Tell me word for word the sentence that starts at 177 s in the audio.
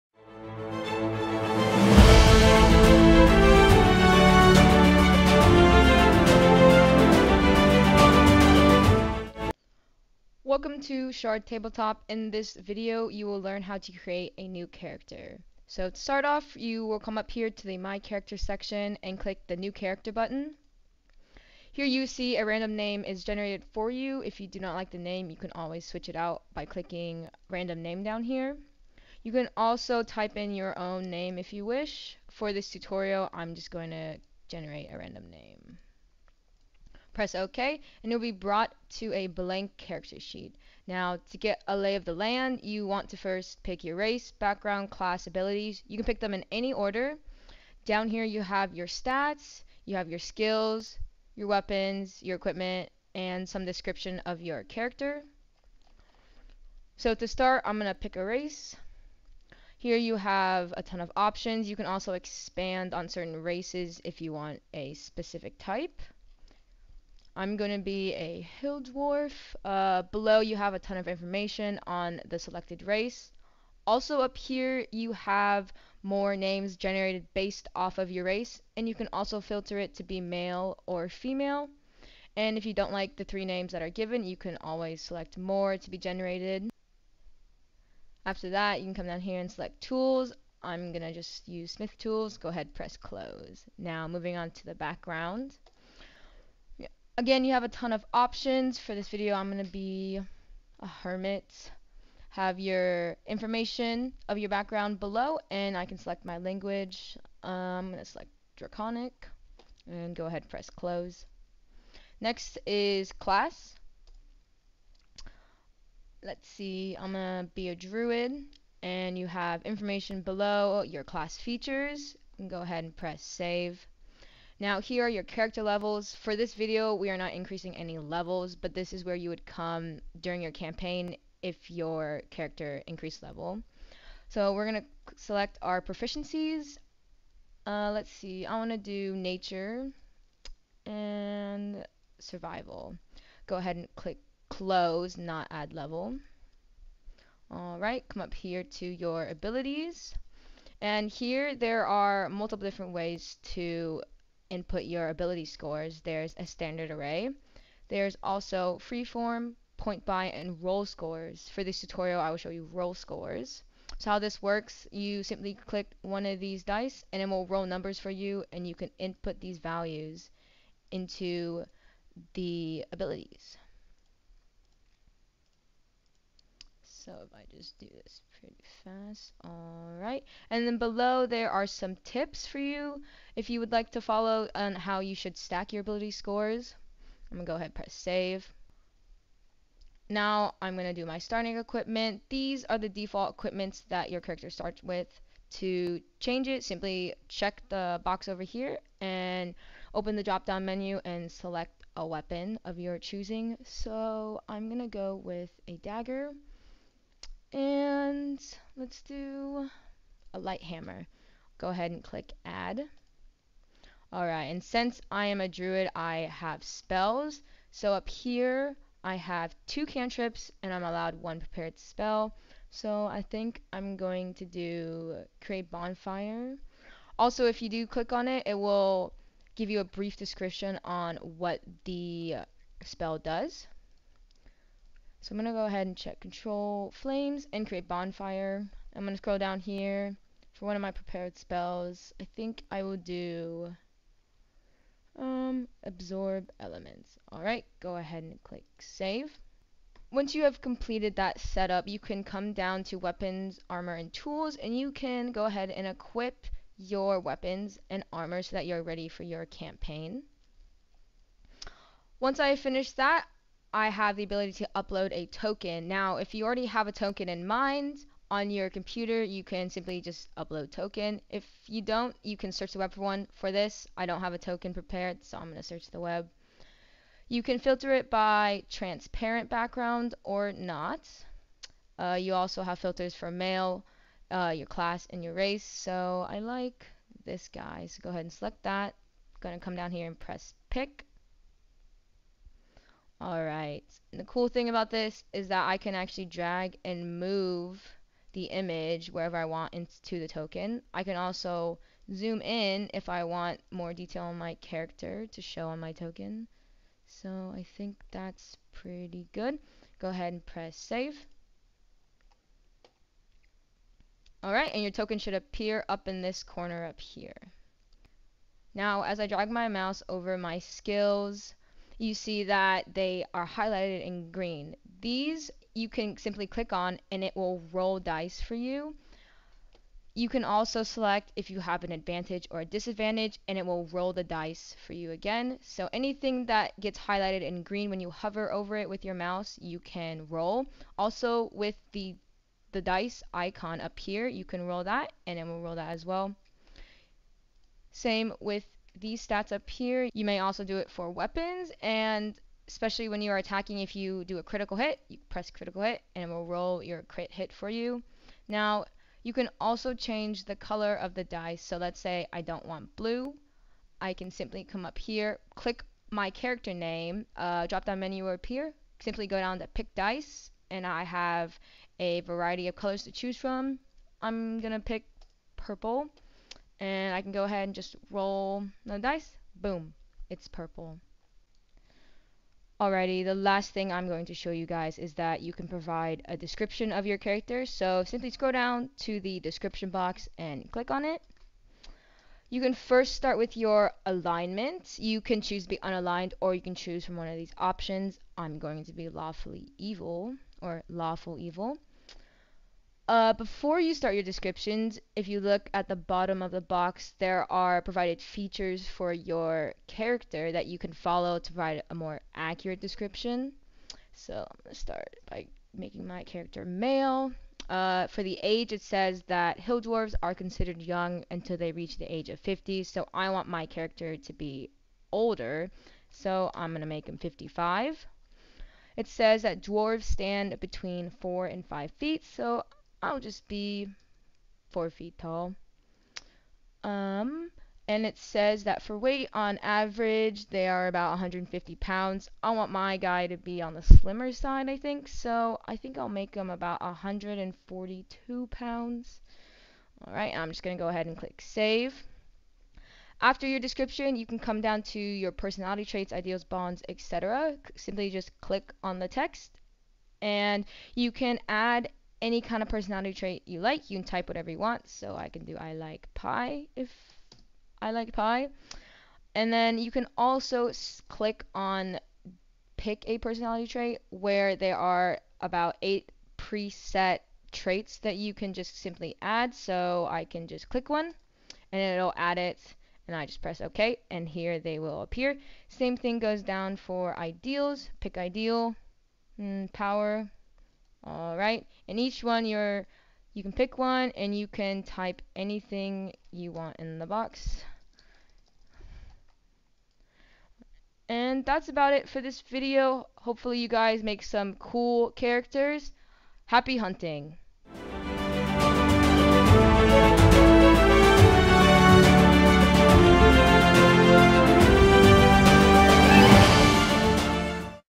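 So if I just do this pretty fast, alright.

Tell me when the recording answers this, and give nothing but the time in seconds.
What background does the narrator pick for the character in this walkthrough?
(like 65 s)
100 s.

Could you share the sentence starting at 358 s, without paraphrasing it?
Now you can also change the color of the dice.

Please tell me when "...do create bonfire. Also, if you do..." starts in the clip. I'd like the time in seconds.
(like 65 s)
224 s.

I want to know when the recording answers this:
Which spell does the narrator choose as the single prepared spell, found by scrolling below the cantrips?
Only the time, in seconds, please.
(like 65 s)
245 s.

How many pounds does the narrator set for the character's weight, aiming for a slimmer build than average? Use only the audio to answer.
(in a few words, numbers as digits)
142.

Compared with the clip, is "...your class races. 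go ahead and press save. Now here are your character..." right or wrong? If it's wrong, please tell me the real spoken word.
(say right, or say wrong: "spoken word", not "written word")
wrong: "features", not "races".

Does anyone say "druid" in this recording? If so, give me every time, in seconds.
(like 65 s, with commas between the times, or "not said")
117 s, 215 s.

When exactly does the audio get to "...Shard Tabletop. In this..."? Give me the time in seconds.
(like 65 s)
11 s.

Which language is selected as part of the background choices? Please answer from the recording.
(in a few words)
Draconic.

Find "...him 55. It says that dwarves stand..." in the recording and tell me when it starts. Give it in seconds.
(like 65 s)
427 s.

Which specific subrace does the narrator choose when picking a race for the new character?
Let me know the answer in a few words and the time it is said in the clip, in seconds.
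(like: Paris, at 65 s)
Hill dwarf, at 68 s.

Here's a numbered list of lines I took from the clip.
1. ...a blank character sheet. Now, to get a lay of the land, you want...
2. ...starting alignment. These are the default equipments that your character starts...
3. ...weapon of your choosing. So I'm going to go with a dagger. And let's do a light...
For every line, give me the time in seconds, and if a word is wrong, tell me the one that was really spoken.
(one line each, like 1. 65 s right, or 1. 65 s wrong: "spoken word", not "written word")
1. 39 s right
2. 191 s wrong: "equipment", not "alignment"
3. 202 s right.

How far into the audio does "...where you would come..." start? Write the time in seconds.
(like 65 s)
129 s.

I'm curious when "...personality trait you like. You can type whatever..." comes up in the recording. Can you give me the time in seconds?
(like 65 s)
462 s.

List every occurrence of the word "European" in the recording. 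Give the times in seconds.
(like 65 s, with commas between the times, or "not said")
not said.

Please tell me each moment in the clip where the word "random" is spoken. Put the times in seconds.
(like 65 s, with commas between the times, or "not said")
22 s, 27 s, 34 s.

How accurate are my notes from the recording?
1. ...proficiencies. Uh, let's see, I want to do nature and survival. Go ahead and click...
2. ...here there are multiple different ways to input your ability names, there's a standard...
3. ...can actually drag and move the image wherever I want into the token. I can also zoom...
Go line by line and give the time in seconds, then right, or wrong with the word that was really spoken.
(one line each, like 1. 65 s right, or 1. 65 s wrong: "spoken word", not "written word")
1. 135 s right
2. 151 s wrong: "scores", not "names"
3. 295 s right.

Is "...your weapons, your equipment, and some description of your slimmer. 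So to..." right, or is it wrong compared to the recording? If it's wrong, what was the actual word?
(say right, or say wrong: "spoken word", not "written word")
wrong: "character", not "slimmer".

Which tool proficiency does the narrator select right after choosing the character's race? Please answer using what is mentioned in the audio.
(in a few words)
Smith Tools.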